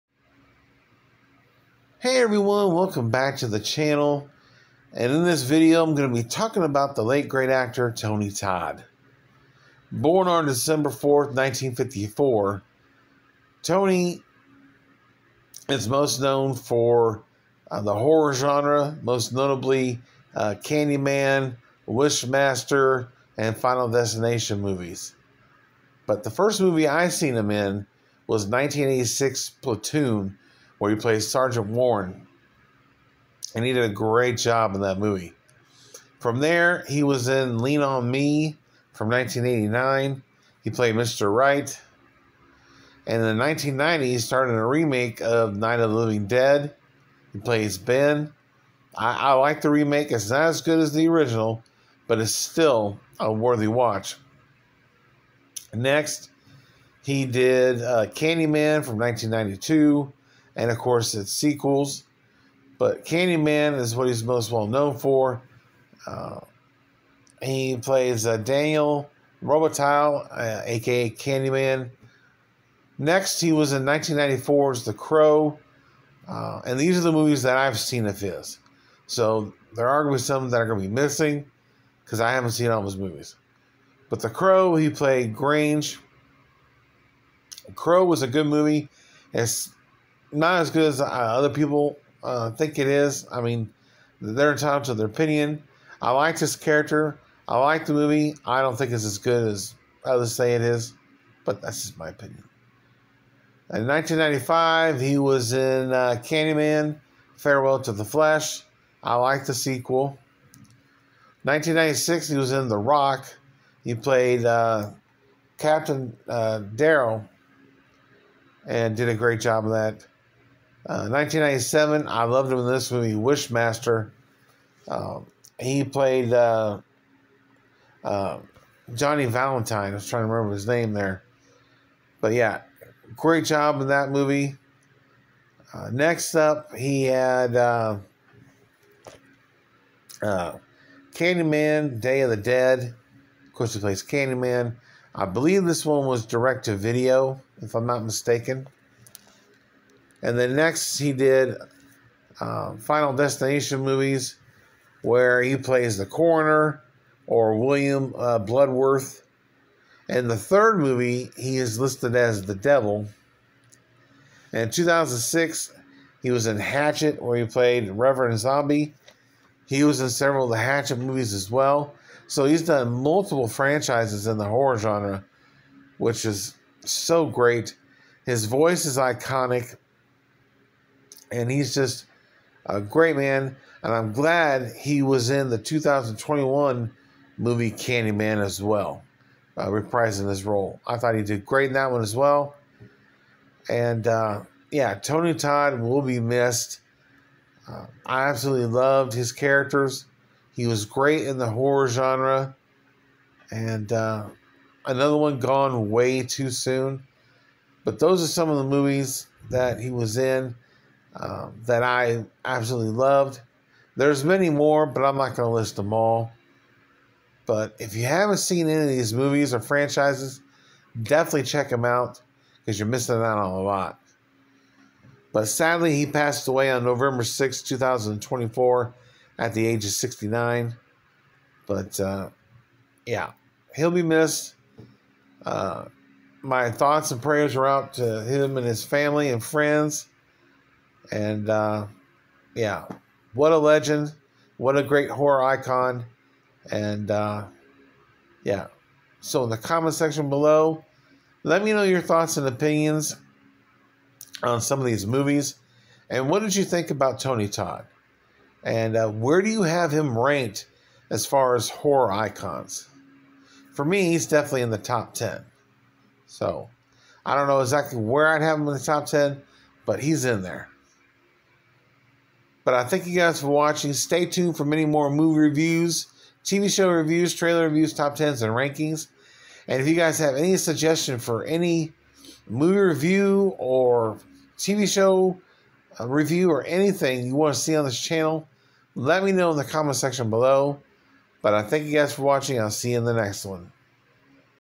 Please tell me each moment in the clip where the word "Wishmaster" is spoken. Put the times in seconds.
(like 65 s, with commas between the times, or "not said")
21 s, 123 s.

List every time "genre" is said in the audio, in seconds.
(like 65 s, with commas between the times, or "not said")
18 s, 174 s, 201 s.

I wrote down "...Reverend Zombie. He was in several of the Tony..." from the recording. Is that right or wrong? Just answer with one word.
wrong.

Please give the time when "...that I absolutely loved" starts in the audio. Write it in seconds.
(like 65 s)
211 s.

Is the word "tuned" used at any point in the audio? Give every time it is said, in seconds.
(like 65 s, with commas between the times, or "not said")
274 s.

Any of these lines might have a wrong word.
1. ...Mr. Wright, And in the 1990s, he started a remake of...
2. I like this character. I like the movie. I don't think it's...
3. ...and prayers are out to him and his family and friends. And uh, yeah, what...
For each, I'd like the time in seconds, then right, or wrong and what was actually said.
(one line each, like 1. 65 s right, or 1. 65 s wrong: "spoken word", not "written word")
1. 40 s right
2. 96 s right
3. 237 s right.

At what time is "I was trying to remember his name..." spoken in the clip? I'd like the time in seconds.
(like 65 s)
129 s.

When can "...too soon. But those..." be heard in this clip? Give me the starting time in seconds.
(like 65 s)
206 s.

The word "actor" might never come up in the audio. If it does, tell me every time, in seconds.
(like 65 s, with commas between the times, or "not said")
7 s.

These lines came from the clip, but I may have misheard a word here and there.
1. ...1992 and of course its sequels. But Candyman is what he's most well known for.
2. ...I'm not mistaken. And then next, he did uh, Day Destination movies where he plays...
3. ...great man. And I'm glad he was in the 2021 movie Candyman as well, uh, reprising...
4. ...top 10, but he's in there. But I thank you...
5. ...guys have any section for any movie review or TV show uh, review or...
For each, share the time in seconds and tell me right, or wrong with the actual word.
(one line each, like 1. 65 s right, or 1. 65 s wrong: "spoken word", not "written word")
1. 58 s right
2. 147 s wrong: "Final", not "Day"
3. 182 s right
4. 268 s right
5. 279 s wrong: "suggestion", not "section".